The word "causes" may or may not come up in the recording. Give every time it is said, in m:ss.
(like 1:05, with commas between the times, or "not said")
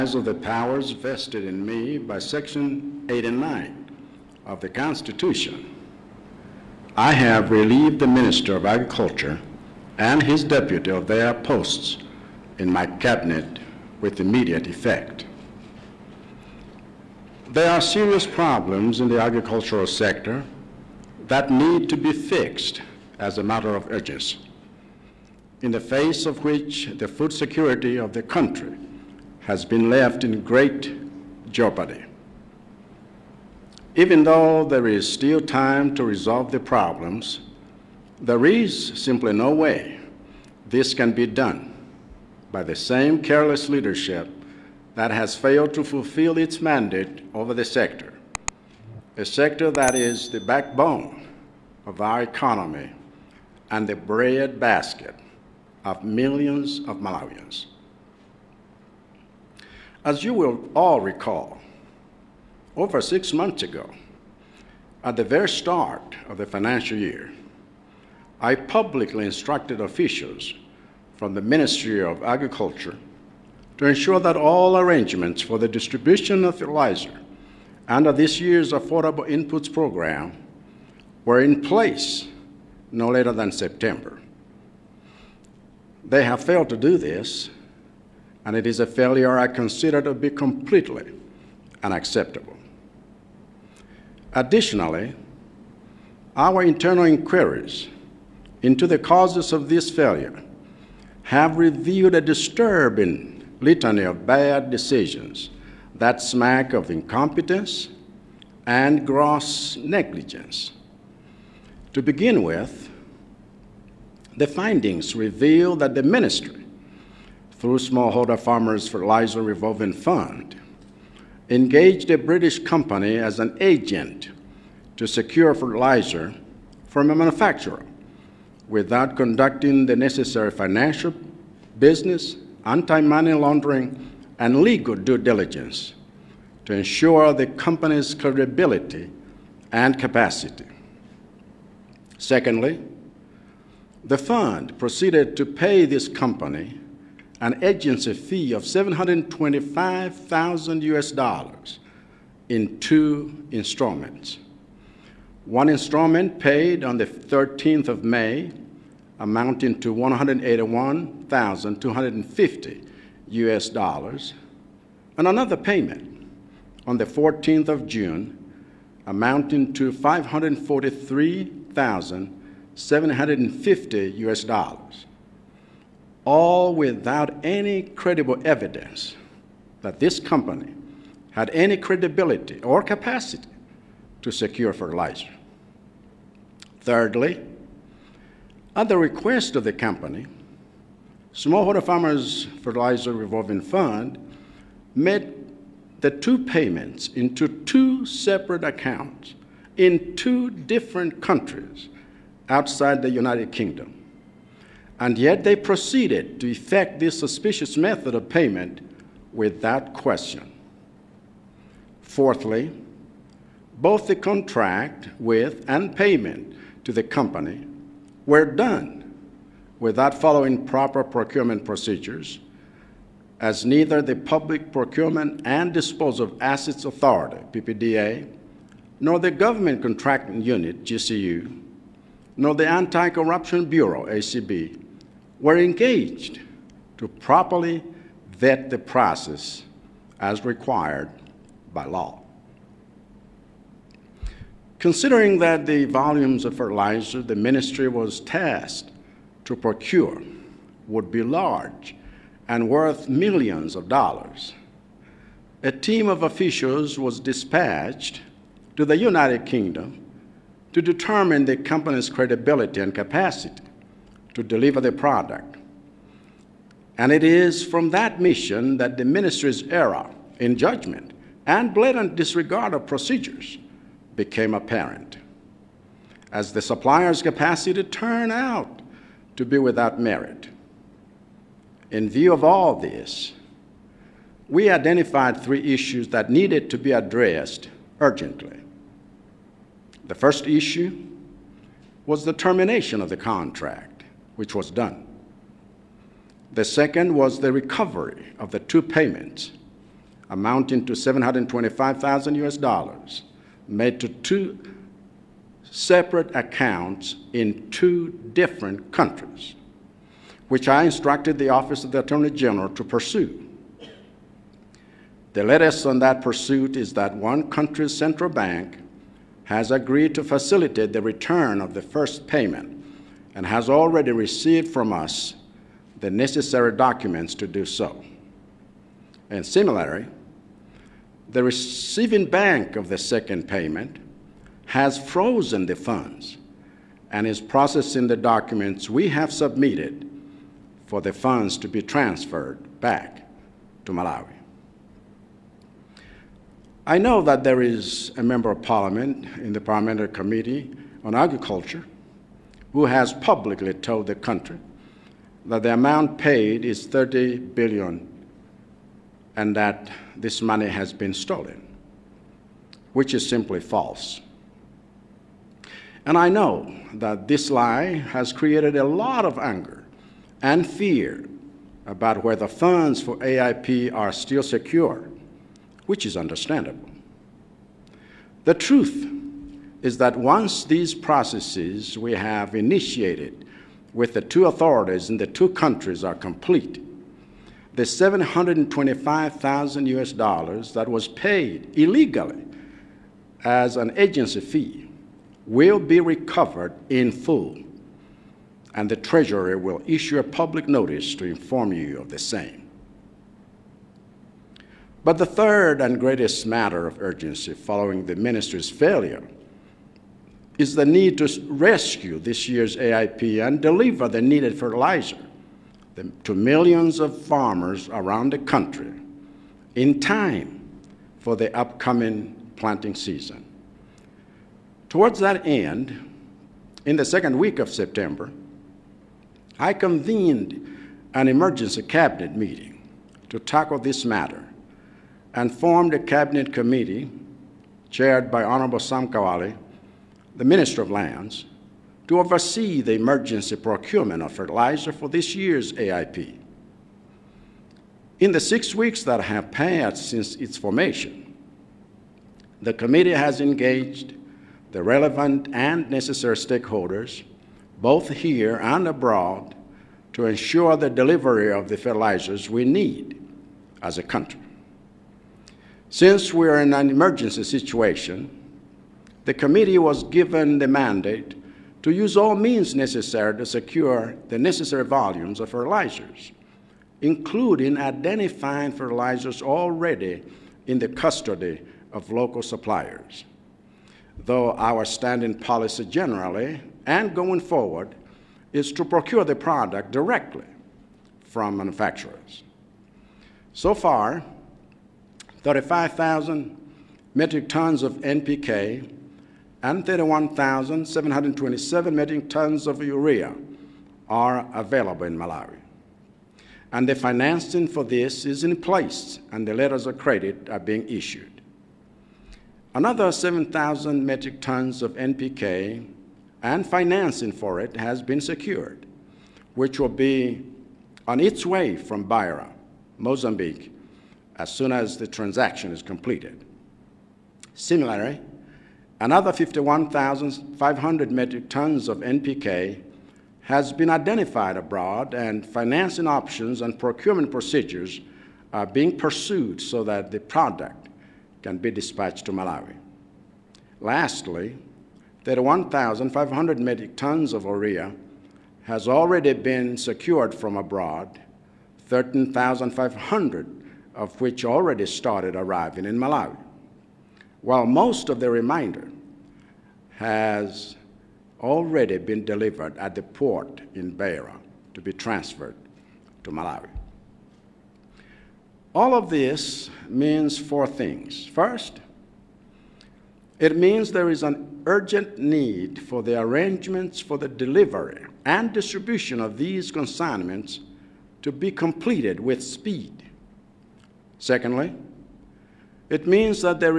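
1:38.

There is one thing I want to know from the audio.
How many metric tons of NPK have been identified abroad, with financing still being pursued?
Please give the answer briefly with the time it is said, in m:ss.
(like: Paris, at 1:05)
51,500, at 8:49.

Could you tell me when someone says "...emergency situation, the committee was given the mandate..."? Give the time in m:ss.
7:46.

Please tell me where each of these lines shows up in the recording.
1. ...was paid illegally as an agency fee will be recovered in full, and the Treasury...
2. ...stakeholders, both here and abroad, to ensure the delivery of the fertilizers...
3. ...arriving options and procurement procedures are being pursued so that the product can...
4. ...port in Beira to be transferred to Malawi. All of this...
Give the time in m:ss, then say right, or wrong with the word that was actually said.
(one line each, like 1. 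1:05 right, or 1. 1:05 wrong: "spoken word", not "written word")
1. 6:30 right
2. 7:36 right
3. 8:55 wrong: "financing", not "arriving"
4. 9:23 right.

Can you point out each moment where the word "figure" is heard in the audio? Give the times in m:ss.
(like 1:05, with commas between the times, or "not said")
not said.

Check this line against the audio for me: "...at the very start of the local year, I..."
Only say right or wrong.
wrong.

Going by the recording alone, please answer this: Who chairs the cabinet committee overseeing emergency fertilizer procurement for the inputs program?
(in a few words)
Sam Kawale.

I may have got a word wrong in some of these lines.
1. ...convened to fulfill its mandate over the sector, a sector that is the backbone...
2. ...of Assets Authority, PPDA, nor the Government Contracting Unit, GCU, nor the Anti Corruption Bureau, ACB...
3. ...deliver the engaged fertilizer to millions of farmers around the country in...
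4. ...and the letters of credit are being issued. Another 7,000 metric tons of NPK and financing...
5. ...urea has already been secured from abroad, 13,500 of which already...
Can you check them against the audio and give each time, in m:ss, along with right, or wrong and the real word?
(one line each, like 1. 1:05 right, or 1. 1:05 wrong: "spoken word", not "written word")
1. 0:45 wrong: "failed", not "convened"
2. 3:46 right
3. 6:53 wrong: "needed", not "engaged"
4. 8:29 right
5. 9:07 right.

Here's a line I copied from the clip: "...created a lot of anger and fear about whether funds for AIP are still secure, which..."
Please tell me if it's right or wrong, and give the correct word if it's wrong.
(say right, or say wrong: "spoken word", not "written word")
right.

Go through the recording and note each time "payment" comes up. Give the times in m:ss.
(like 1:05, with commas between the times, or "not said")
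3:16, 3:28, 3:35, 4:58, 5:22, 5:33.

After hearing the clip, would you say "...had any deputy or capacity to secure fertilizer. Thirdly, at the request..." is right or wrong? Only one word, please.
wrong.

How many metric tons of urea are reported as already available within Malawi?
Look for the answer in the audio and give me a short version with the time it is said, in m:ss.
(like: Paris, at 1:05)
31,727, at 8:19.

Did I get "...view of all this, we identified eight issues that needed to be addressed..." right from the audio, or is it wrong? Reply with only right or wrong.
wrong.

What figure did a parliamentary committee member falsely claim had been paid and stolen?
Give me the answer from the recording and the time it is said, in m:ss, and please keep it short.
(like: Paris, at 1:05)
30 billion, at 5:56.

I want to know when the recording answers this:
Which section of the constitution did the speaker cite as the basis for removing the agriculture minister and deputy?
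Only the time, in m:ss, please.
0:02.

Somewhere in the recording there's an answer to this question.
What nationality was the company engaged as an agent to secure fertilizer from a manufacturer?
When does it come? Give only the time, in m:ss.
2:02.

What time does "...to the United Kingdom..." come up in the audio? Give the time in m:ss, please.
4:18.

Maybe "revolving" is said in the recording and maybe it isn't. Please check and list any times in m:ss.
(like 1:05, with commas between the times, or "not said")
1:59, 3:13.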